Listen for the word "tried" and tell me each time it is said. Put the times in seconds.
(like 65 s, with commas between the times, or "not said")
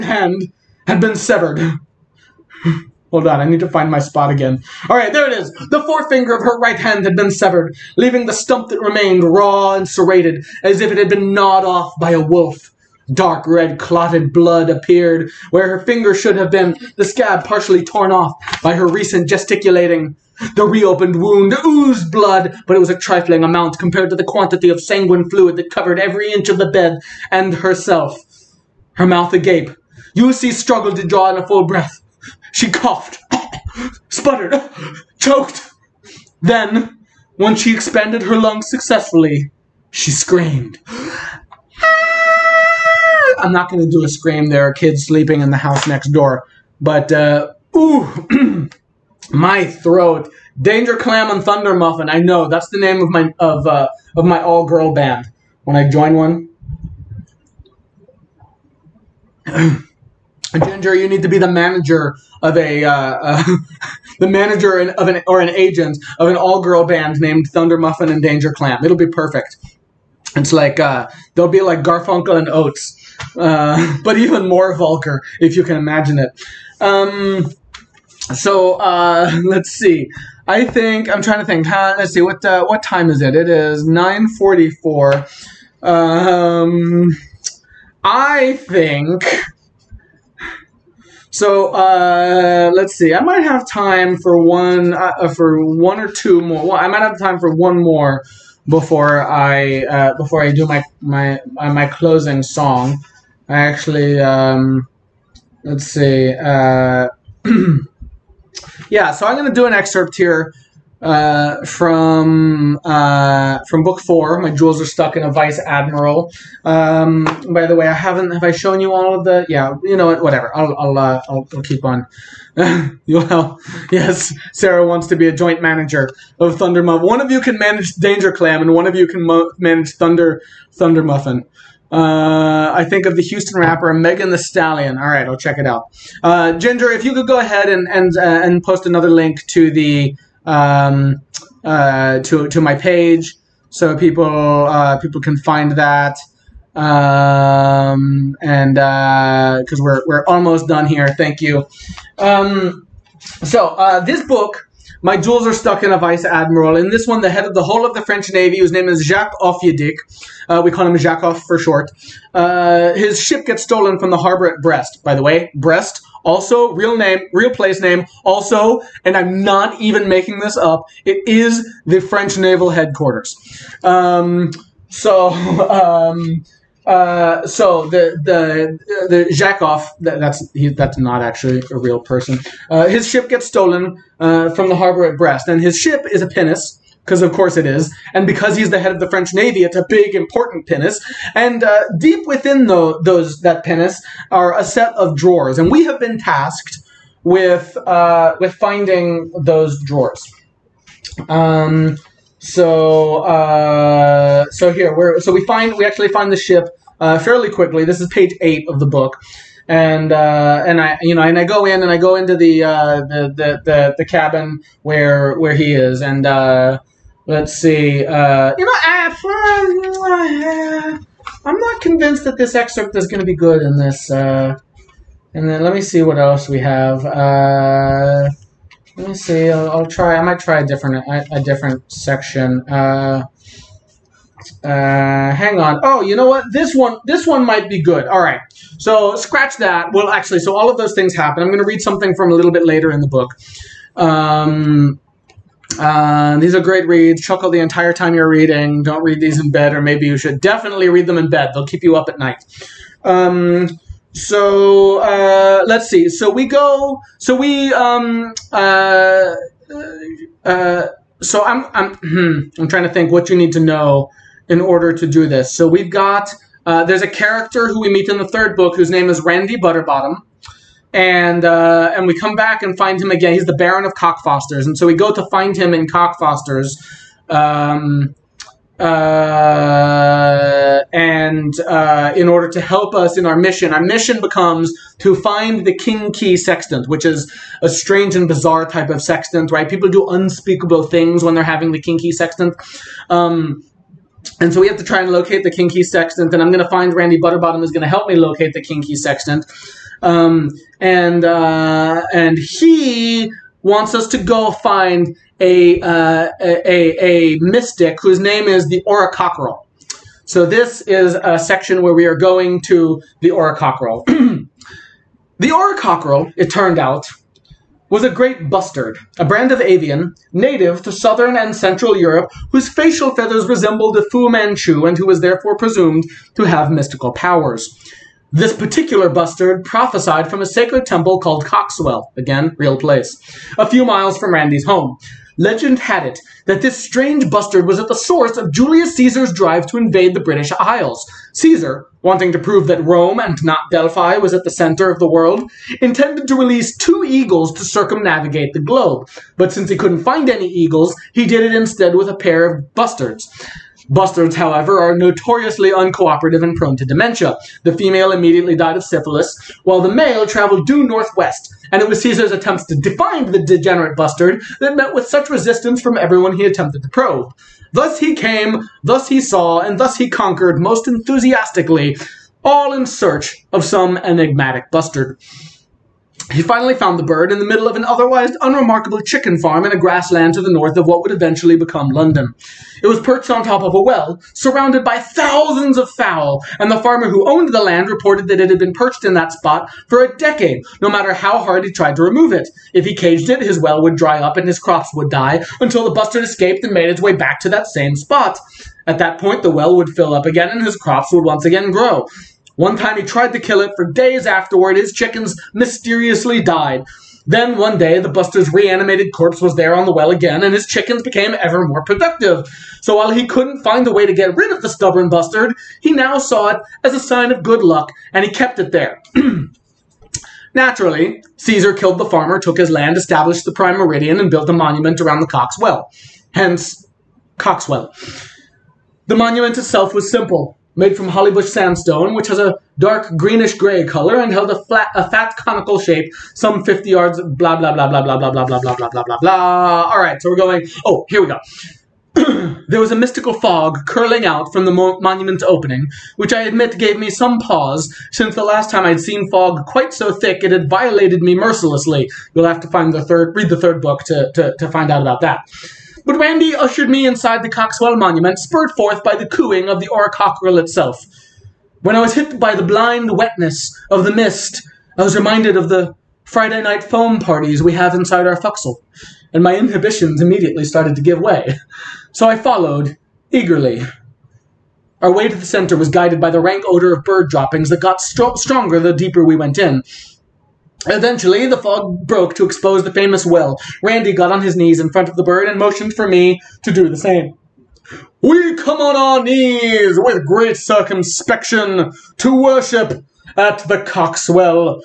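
391 s, 403 s.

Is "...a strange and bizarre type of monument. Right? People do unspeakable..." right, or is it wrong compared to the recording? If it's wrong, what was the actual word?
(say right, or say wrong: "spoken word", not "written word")
wrong: "sextant", not "monument".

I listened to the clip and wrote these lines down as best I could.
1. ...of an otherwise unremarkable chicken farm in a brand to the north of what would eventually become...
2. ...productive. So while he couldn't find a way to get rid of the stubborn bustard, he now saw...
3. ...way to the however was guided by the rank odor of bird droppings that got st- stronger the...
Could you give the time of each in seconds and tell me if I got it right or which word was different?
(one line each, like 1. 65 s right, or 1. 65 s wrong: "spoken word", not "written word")
1. 377 s wrong: "grassland", not "brand"
2. 411 s right
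3. 475 s wrong: "center", not "however".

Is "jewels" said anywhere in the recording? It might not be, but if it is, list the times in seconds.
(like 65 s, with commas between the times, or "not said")
114 s, 155 s.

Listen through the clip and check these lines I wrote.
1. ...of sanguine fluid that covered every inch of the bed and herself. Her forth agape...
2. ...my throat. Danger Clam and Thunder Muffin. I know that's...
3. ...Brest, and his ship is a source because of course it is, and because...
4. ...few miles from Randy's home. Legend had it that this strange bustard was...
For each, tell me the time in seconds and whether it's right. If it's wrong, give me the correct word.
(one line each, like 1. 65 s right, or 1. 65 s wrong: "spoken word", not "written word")
1. 24 s wrong: "mouth", not "forth"
2. 49 s right
3. 185 s wrong: "pinnace", not "source"
4. 333 s right.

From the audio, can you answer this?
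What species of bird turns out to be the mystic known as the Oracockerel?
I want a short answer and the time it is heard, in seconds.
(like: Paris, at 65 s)
Great bustard, at 318 s.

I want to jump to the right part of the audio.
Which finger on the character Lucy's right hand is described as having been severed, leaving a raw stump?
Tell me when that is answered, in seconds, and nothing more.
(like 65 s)
5 s.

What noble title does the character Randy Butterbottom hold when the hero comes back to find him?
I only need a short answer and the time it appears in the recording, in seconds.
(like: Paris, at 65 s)
Baron of Cockfosters, at 273 s.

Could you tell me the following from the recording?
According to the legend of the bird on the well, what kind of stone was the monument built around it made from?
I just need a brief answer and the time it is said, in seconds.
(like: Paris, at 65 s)
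Hollybush sandstone, at 431 s.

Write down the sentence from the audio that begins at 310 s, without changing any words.
So this is a section where we are going to the Oracockerel.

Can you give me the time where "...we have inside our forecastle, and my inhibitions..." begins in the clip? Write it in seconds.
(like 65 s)
467 s.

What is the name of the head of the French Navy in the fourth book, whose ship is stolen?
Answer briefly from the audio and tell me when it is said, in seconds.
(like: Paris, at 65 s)
Jacques Offiedik, at 159 s.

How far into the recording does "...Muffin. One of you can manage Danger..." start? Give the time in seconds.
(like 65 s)
126 s.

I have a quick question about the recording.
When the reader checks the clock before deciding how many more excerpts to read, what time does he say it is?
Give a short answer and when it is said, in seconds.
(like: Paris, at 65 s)
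9:44, at 83 s.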